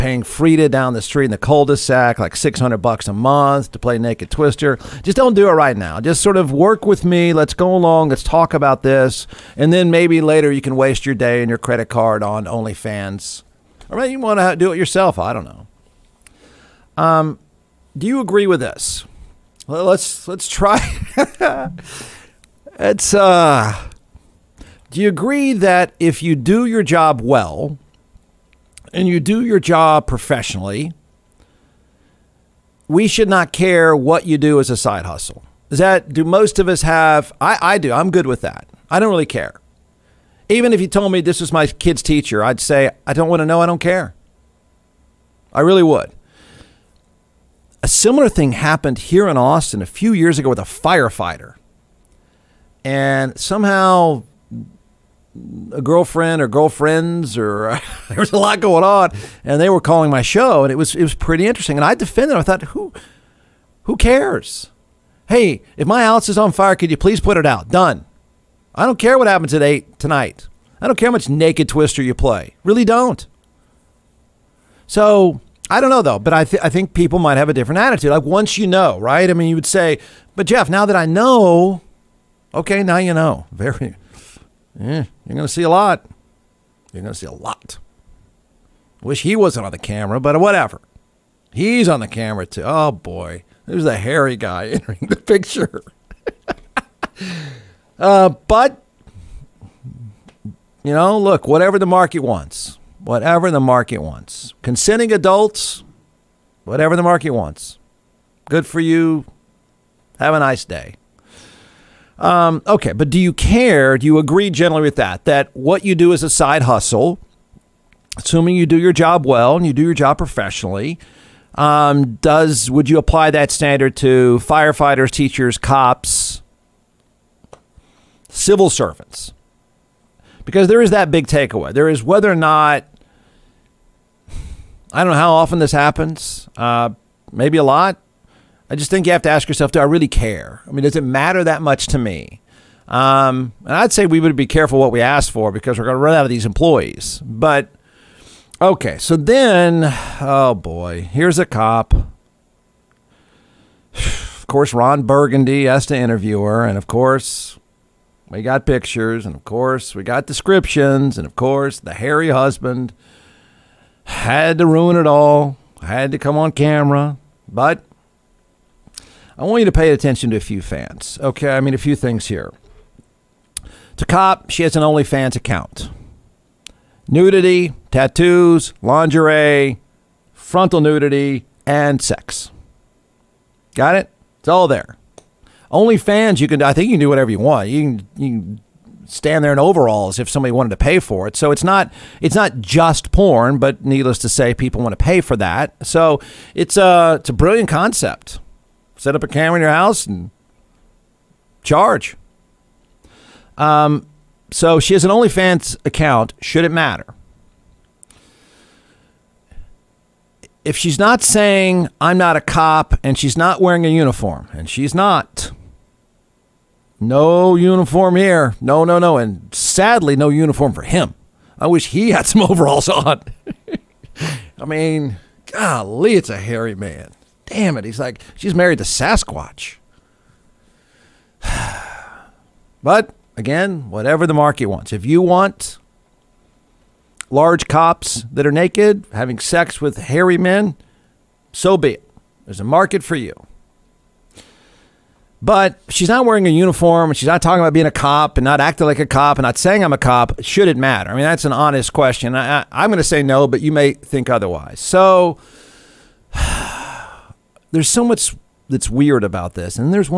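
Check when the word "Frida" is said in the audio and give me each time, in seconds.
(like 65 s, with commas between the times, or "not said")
0 s.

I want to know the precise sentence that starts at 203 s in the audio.
Um, so she has an OnlyFans account.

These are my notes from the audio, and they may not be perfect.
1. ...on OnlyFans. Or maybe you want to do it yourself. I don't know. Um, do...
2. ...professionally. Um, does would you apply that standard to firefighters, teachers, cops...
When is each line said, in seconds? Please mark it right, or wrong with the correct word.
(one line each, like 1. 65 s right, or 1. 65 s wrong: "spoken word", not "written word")
1. 12 s right
2. 120 s right.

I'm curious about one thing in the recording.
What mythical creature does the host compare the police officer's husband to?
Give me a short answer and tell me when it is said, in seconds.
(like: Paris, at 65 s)
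Sasquatch, at 228 s.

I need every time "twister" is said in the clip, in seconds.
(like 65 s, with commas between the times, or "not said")
4 s, 71 s.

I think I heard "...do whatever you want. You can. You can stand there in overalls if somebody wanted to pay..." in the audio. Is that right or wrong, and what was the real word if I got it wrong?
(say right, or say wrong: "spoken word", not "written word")
right.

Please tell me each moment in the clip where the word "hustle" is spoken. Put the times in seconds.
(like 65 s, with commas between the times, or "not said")
35 s, 116 s.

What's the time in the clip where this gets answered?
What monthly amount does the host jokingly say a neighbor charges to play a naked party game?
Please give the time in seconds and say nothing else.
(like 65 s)
2 s.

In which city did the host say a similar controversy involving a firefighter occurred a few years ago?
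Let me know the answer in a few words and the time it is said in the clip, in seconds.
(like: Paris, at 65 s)
Austin, at 49 s.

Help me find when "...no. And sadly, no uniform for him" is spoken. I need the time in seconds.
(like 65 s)
218 s.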